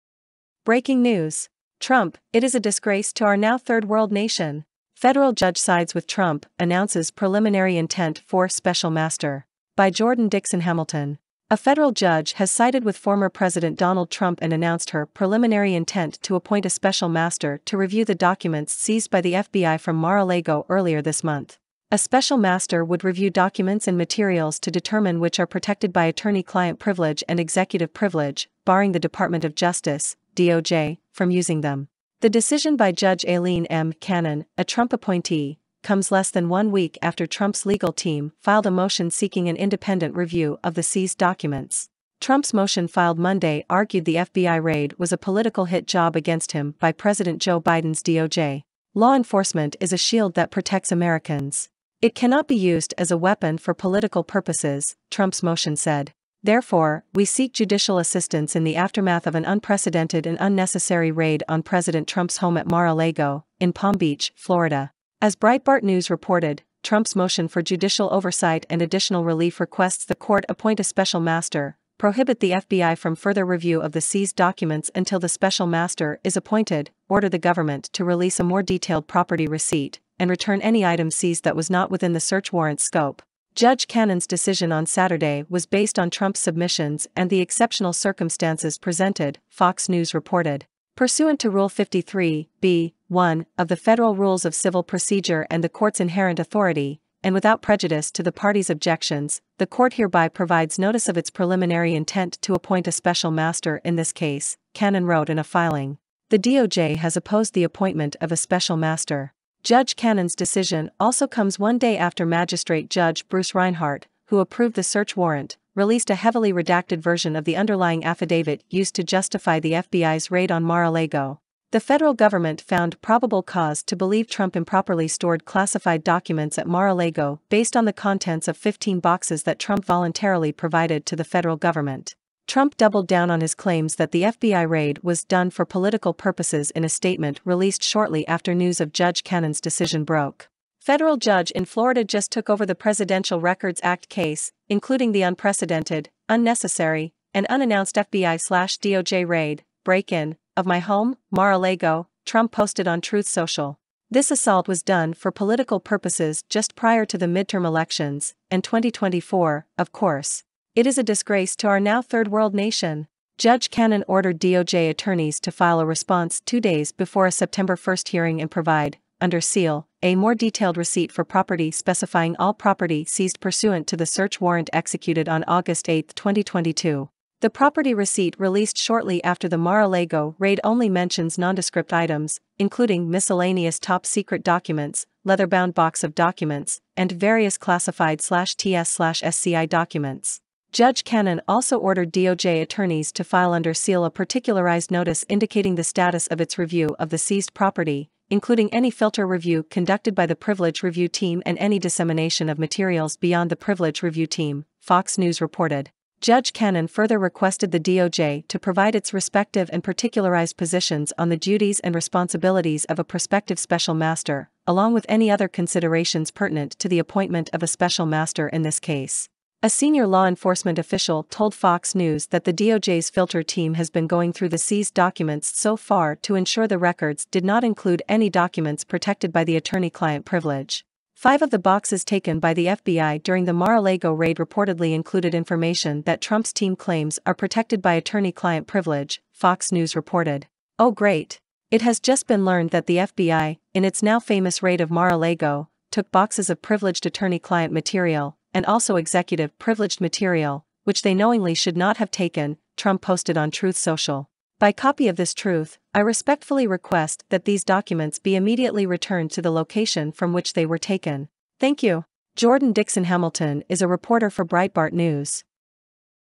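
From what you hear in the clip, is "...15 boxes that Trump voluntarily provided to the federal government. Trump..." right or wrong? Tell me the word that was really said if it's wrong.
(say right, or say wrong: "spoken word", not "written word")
right.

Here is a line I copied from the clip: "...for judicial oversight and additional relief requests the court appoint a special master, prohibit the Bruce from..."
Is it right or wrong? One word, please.
wrong.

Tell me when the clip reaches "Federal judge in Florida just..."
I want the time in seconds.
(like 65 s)
140 s.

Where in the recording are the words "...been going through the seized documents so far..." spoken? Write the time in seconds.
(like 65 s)
223 s.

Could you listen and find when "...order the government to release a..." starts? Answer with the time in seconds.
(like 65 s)
77 s.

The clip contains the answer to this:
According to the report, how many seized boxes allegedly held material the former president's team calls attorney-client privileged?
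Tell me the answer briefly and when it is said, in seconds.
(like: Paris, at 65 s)
5, at 231 s.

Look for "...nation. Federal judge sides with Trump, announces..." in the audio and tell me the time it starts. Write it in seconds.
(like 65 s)
4 s.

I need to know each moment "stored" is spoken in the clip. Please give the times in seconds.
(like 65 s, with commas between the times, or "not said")
125 s.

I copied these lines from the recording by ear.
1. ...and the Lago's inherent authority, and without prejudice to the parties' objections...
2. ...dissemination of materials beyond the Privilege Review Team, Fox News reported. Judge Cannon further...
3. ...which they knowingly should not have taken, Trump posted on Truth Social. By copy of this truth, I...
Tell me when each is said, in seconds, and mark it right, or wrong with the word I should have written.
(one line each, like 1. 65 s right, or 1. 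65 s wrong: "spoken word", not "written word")
1. 95 s wrong: "Court", not "Lago"
2. 201 s right
3. 250 s right.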